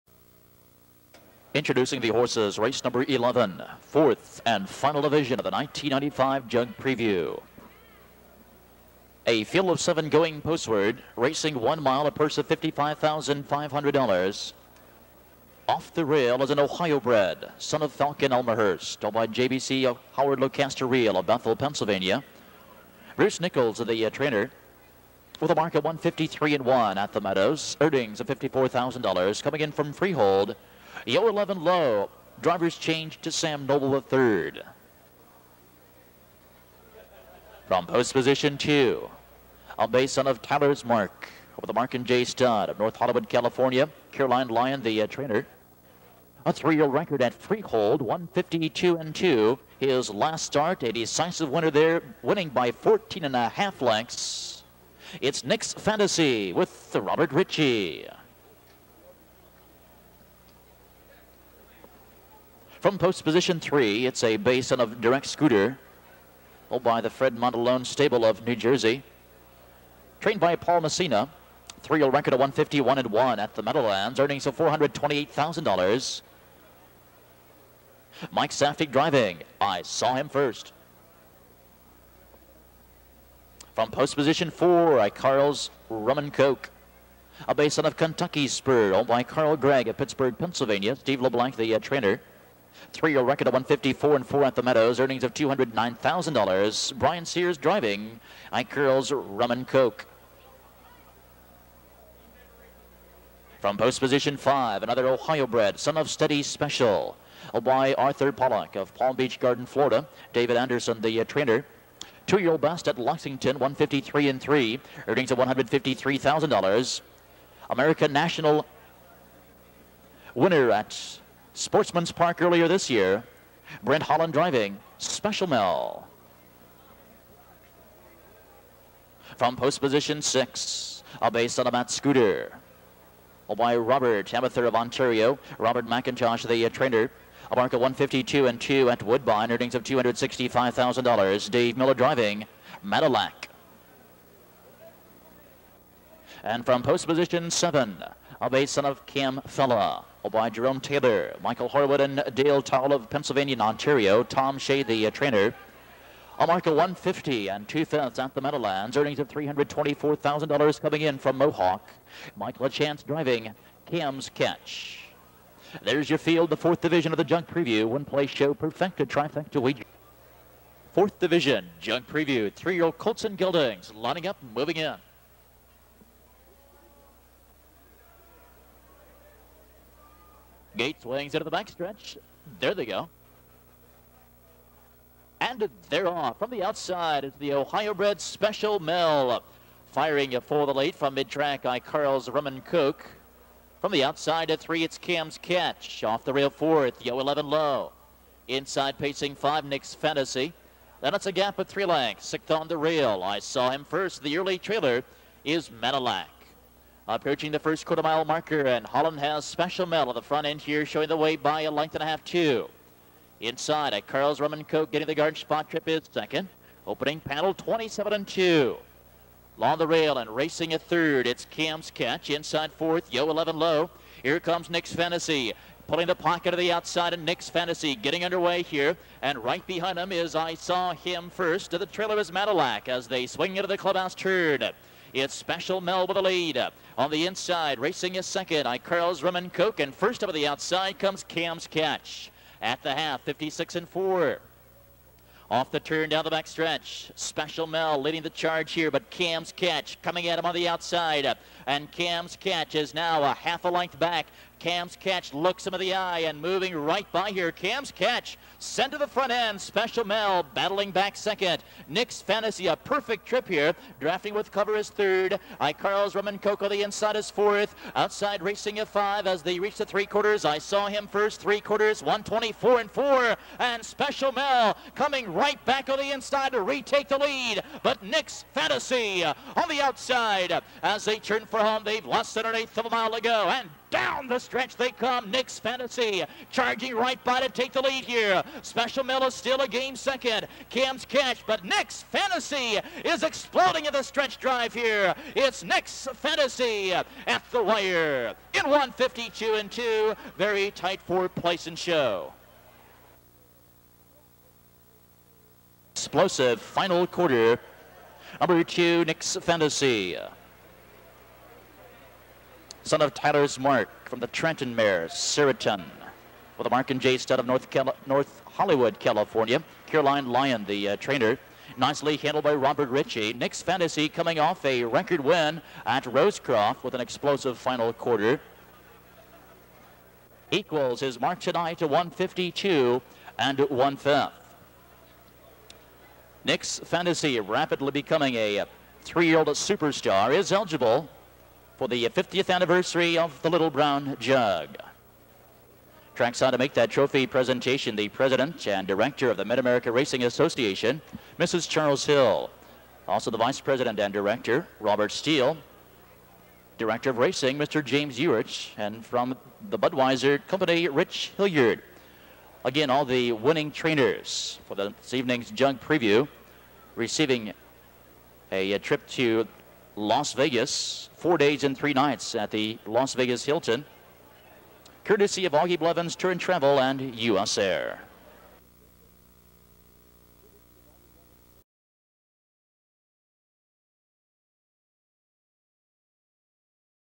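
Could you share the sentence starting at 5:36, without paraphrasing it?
Nick's Fantasy rapidly becoming a uh, three-year-old superstar is eligible for the 50th anniversary of the Little Brown Jug.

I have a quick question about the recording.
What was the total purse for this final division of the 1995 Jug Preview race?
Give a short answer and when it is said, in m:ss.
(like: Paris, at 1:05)
$55,500, at 0:12.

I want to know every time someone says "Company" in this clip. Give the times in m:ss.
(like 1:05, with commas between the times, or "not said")
6:00.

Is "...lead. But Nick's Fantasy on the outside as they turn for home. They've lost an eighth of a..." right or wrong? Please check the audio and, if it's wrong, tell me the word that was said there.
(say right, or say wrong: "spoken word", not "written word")
right.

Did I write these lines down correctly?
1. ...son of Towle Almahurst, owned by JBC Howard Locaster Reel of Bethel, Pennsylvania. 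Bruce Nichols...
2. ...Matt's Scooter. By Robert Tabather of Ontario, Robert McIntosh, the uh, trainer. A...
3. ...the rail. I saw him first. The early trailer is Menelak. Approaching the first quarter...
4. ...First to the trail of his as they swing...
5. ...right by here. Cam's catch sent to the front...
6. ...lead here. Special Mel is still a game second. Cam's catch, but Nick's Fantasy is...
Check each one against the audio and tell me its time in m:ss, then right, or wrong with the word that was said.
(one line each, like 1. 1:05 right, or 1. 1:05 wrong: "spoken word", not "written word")
1. 0:17 wrong: "Falcon", not "Towle"
2. 2:11 right
3. 3:22 right
4. 3:51 right
5. 4:16 right
6. 4:47 right.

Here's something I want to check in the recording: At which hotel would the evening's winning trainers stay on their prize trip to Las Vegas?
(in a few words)
Las Vegas Hilton.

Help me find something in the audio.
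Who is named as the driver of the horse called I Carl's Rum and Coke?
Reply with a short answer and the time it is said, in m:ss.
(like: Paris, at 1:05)
Brian Sears, at 1:36.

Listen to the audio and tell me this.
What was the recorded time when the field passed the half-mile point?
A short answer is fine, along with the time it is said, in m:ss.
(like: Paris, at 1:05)
56 and 4, at 4:03.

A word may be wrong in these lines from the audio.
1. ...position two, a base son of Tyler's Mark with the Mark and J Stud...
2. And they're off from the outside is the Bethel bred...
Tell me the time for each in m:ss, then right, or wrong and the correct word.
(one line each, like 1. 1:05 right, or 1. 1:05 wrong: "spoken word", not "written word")
1. 0:38 right
2. 3:05 wrong: "Ohio", not "Bethel".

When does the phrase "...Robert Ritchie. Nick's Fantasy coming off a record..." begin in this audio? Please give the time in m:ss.
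5:22.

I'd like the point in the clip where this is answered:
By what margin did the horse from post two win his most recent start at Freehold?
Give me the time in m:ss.
0:52.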